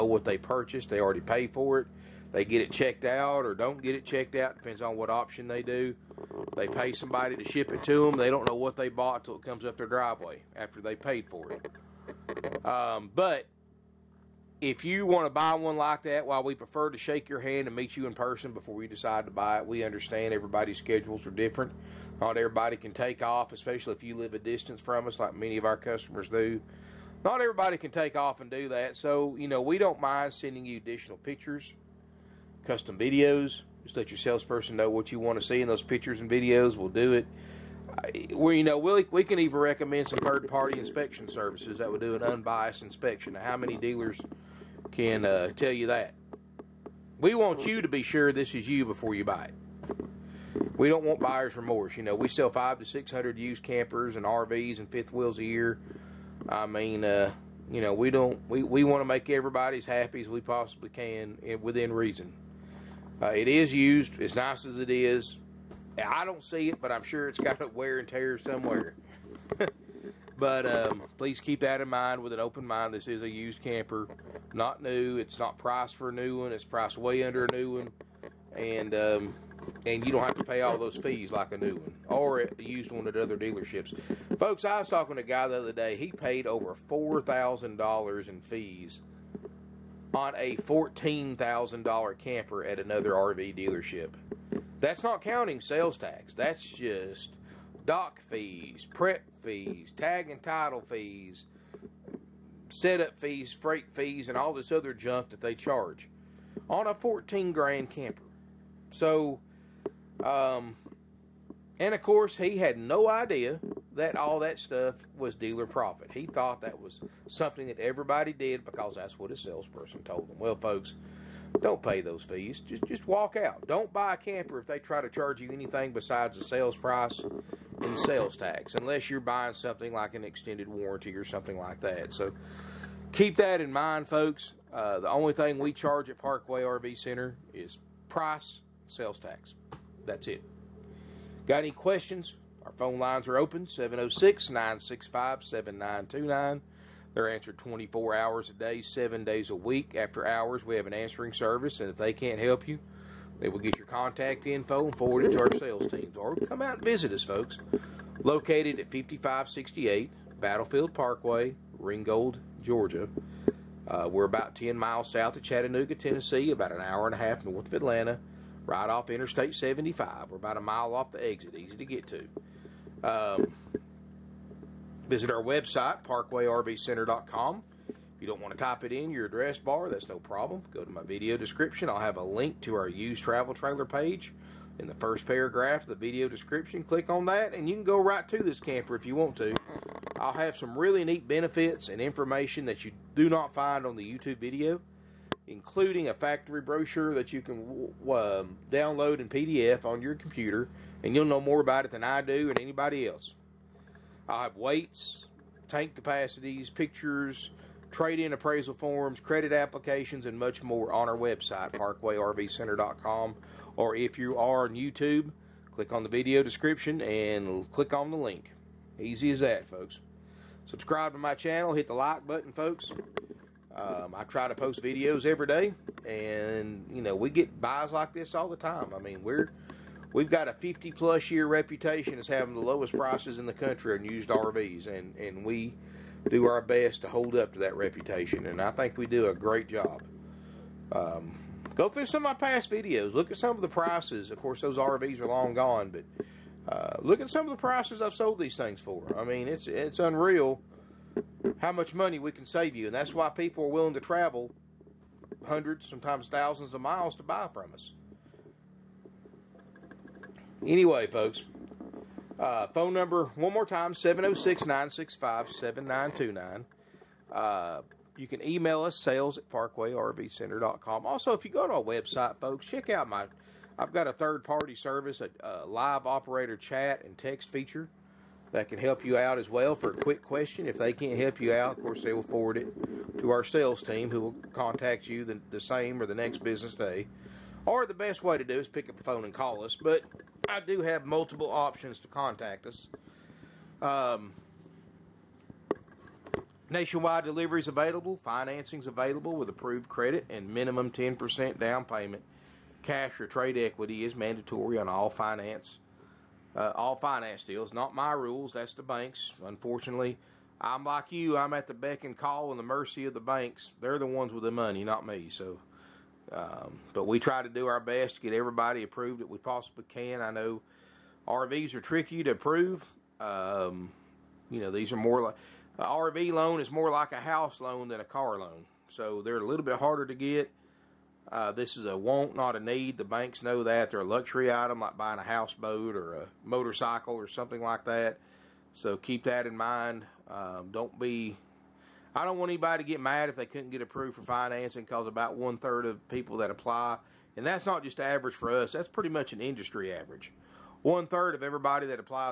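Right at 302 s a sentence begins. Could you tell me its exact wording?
Cash or trade equity is mandatory on all finance uh, all finance deals.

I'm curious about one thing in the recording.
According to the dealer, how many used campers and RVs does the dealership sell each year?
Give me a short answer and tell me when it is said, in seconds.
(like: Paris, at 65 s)
500 to 600, at 52 s.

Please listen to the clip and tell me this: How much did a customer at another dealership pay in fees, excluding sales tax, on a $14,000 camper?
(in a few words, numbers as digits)
over $4,000.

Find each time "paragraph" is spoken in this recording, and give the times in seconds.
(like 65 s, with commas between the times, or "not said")
185 s.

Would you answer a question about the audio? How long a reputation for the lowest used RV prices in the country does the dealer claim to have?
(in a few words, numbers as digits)
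50 plus years.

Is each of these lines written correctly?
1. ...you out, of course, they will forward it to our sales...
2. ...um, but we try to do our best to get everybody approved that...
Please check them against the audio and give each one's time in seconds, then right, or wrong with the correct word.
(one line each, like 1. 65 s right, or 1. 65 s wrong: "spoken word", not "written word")
1. 281 s right
2. 316 s right.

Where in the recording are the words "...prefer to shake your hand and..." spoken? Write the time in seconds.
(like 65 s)
16 s.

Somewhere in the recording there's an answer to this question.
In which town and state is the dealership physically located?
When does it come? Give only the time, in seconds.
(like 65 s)
161 s.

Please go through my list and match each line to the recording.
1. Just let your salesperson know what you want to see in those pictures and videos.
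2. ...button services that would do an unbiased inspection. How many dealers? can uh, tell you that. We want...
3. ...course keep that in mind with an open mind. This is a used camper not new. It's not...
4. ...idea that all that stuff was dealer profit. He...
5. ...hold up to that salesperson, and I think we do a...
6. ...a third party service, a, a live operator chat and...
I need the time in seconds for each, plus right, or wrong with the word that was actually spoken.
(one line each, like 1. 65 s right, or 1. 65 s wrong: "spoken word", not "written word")
1. 33 s right
2. 40 s wrong: "inspection", not "button"
3. 71 s wrong: "please", not "course"
4. 113 s right
5. 237 s wrong: "reputation", not "salesperson"
6. 274 s right.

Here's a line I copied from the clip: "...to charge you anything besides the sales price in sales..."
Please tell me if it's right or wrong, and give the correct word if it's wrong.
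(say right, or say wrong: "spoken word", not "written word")
right.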